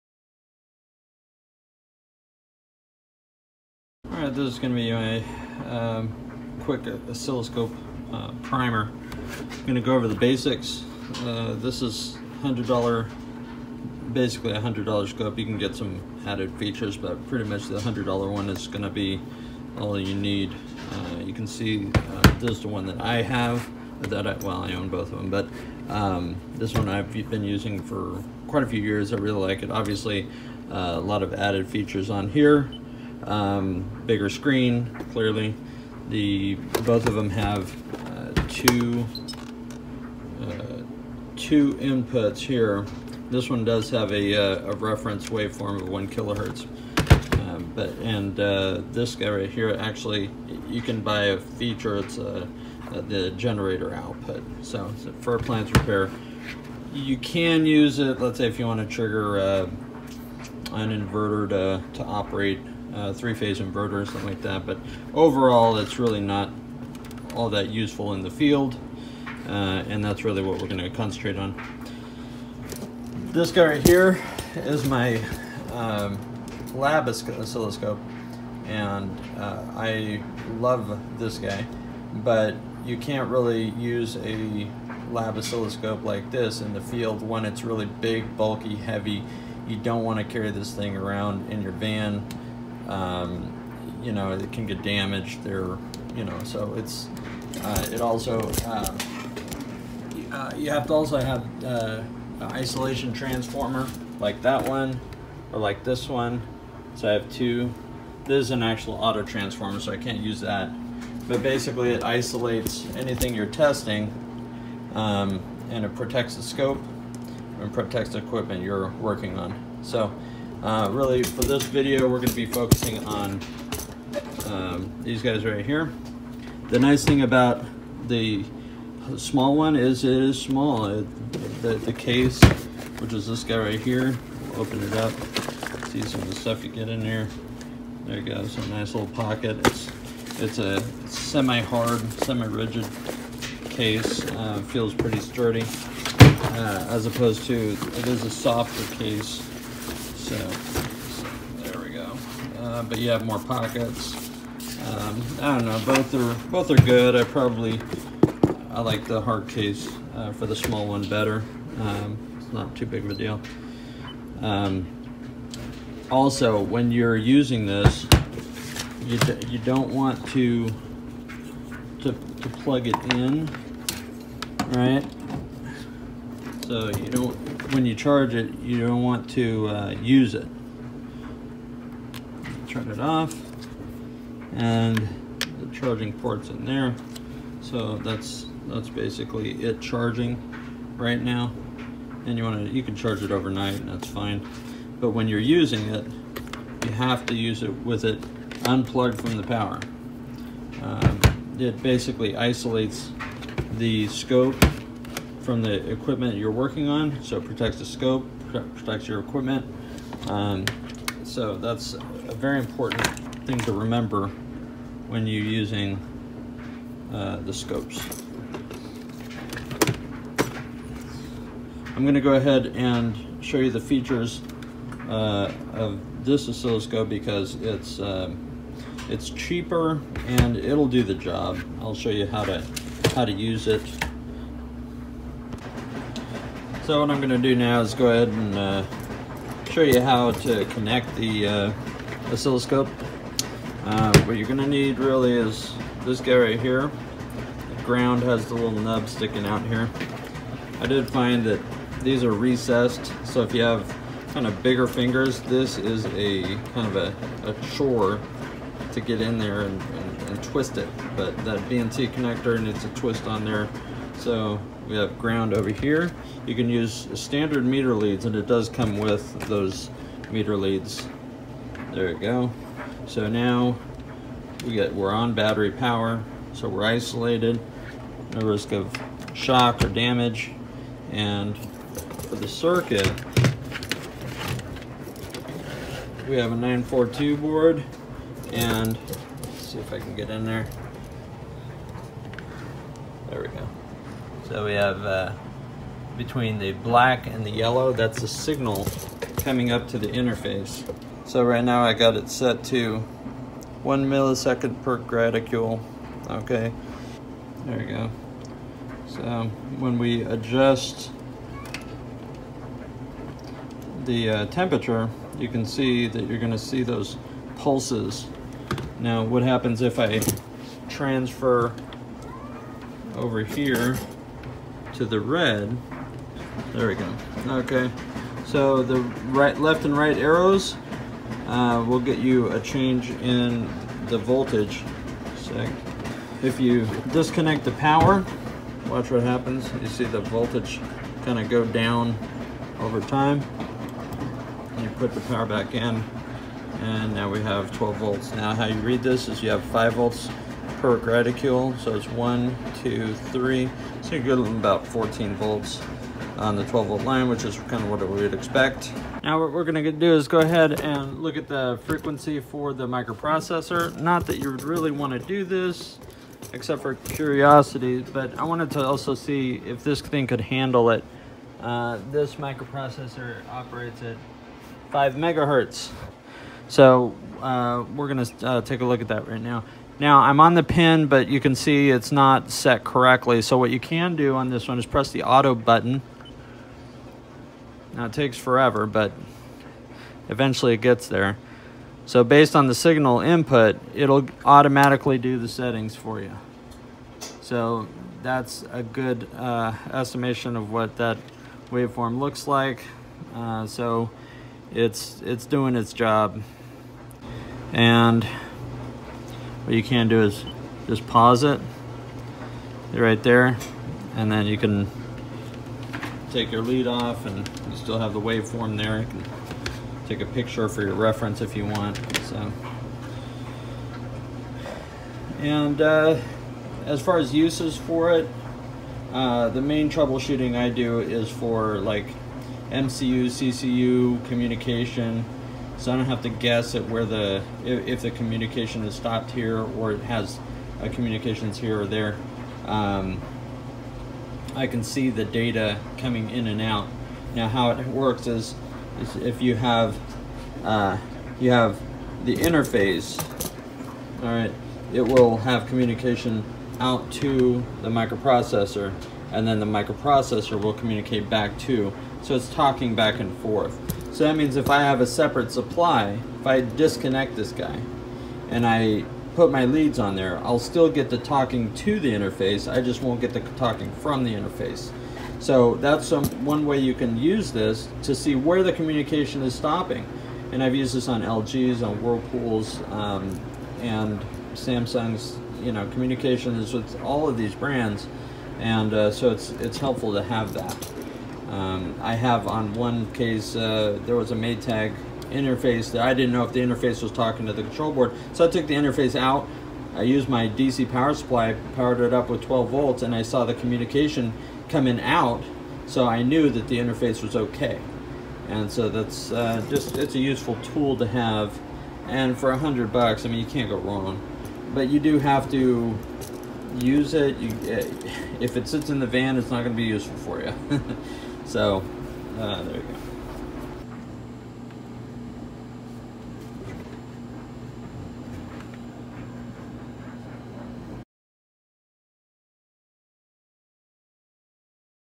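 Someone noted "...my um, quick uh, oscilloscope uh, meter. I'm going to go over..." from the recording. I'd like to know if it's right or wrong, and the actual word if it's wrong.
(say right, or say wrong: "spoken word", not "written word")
wrong: "primer", not "meter".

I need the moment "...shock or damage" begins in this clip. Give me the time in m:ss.
4:39.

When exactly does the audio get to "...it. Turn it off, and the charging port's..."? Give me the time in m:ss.
3:00.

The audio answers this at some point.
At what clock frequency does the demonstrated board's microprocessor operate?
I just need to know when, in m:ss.
6:14.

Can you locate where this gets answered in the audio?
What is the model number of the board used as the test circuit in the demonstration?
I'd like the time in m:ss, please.
4:46.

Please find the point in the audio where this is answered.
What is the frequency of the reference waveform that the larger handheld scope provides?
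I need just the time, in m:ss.
0:45.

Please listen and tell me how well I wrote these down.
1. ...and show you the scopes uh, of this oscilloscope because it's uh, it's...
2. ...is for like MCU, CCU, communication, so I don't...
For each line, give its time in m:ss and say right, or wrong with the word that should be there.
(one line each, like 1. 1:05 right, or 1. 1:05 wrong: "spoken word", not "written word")
1. 3:42 wrong: "features", not "scopes"
2. 7:10 right.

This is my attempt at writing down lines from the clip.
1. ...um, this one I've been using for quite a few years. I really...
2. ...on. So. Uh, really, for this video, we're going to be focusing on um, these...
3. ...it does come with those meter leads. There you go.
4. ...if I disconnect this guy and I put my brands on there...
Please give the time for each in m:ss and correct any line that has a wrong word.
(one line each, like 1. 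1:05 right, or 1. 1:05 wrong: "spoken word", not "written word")
1. 0:25 right
2. 1:59 right
3. 4:28 right
4. 7:46 wrong: "leads", not "brands".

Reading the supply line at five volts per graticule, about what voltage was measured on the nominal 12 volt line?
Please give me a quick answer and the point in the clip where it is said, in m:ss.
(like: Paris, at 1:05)
14 volts, at 5:54.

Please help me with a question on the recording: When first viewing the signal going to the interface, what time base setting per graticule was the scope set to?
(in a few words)
1 millisecond.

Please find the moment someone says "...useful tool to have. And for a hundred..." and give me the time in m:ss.
8:30.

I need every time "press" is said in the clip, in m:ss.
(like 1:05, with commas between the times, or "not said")
6:24.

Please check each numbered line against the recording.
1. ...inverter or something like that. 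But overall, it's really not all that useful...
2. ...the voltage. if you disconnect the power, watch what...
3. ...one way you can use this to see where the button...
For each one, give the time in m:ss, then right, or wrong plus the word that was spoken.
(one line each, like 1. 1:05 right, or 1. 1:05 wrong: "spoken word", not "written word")
1. 1:03 right
2. 5:34 right
3. 7:56 wrong: "communication", not "button".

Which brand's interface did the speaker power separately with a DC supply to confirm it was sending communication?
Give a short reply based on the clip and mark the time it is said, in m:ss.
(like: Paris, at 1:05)
Maytag, at 8:14.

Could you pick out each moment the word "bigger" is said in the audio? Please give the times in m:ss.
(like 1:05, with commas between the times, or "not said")
0:34, 4:14.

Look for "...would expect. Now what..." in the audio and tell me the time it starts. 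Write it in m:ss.
5:58.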